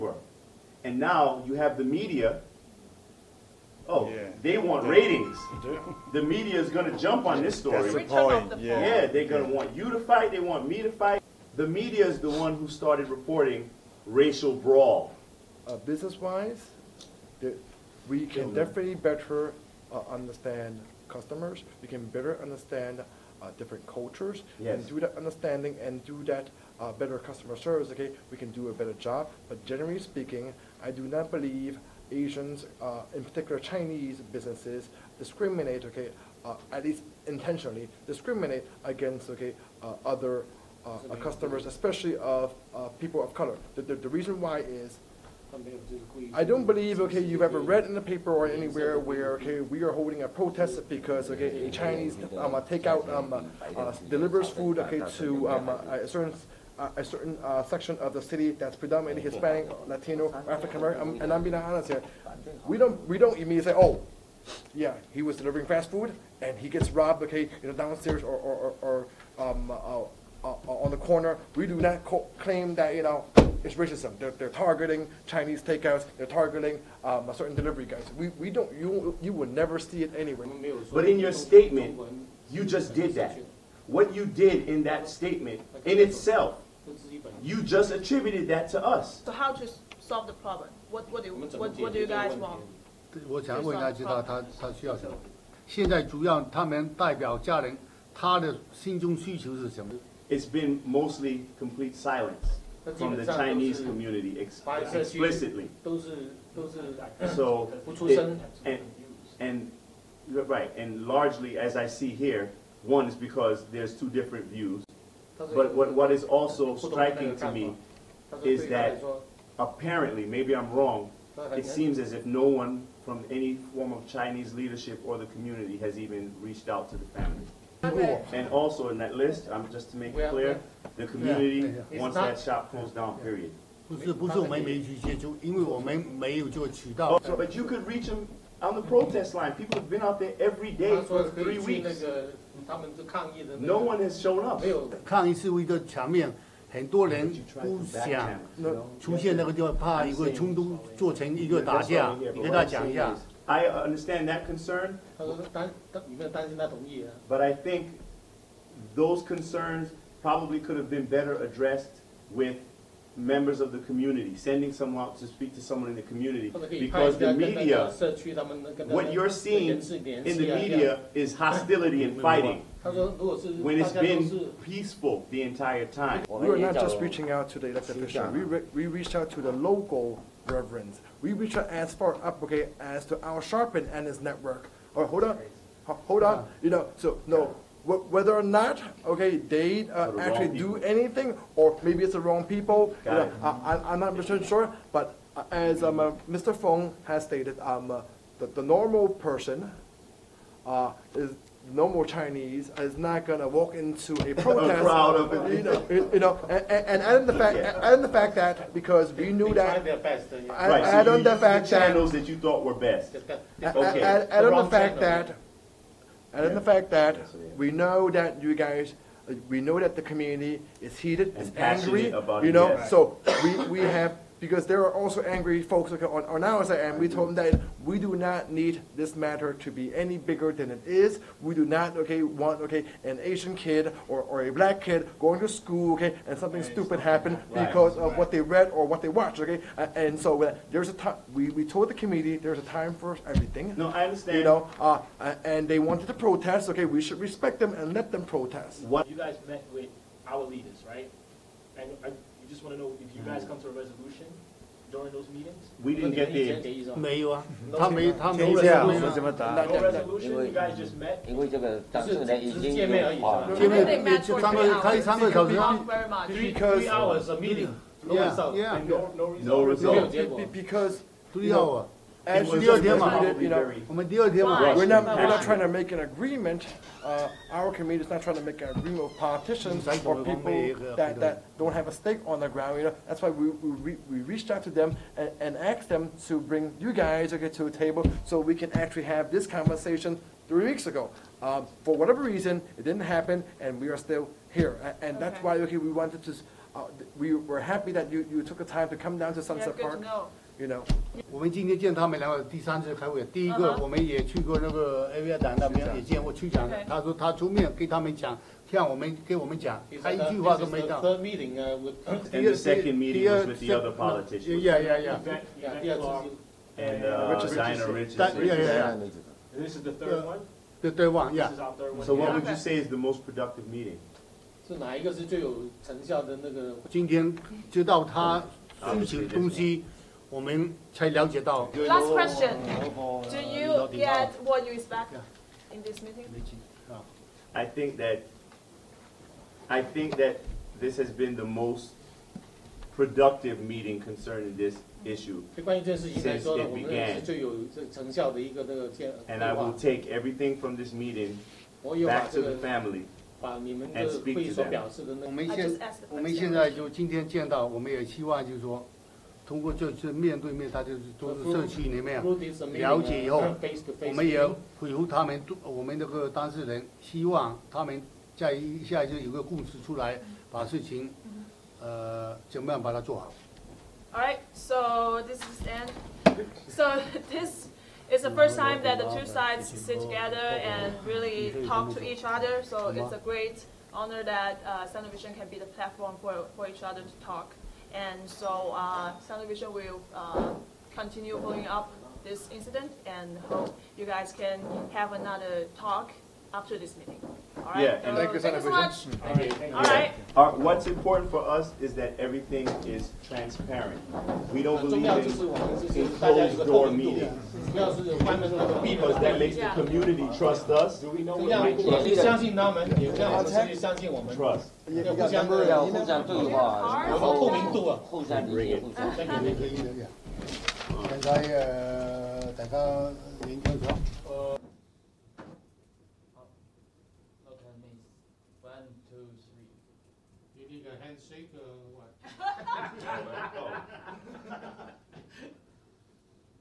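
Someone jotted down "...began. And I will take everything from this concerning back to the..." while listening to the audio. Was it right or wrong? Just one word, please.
wrong.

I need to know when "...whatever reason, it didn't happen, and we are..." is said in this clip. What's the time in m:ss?
4:51.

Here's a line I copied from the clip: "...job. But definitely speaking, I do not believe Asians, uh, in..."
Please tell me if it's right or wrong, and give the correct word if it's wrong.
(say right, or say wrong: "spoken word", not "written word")
wrong: "generally", not "definitely".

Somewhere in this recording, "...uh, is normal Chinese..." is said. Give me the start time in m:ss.
3:20.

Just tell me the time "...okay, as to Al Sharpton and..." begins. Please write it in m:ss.
3:02.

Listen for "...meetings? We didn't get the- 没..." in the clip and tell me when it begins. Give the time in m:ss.
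4:15.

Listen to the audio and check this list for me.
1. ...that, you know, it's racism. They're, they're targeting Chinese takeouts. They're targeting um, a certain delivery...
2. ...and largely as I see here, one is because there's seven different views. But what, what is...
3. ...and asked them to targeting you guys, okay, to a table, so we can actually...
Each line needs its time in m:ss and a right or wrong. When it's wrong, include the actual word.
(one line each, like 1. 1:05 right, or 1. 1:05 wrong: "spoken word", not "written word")
1. 1:12 right
2. 1:50 wrong: "two", not "seven"
3. 4:45 wrong: "bring", not "targeting".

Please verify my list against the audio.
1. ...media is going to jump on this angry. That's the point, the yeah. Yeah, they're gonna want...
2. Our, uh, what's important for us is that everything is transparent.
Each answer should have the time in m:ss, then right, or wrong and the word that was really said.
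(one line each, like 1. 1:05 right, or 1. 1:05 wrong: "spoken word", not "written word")
1. 0:06 wrong: "story", not "angry"
2. 6:40 right.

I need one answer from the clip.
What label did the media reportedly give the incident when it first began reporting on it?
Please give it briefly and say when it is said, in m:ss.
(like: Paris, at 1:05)
racial brawl, at 0:14.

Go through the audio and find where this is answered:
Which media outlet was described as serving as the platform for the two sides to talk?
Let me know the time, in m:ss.
6:24.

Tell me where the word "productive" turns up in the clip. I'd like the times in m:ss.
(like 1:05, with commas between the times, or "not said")
5:23, 5:42.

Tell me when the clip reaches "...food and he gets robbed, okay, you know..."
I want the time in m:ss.
1:05.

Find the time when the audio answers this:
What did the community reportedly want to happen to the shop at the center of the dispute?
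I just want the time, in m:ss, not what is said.
2:12.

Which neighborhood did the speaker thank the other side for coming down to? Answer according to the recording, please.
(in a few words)
Sunset Park.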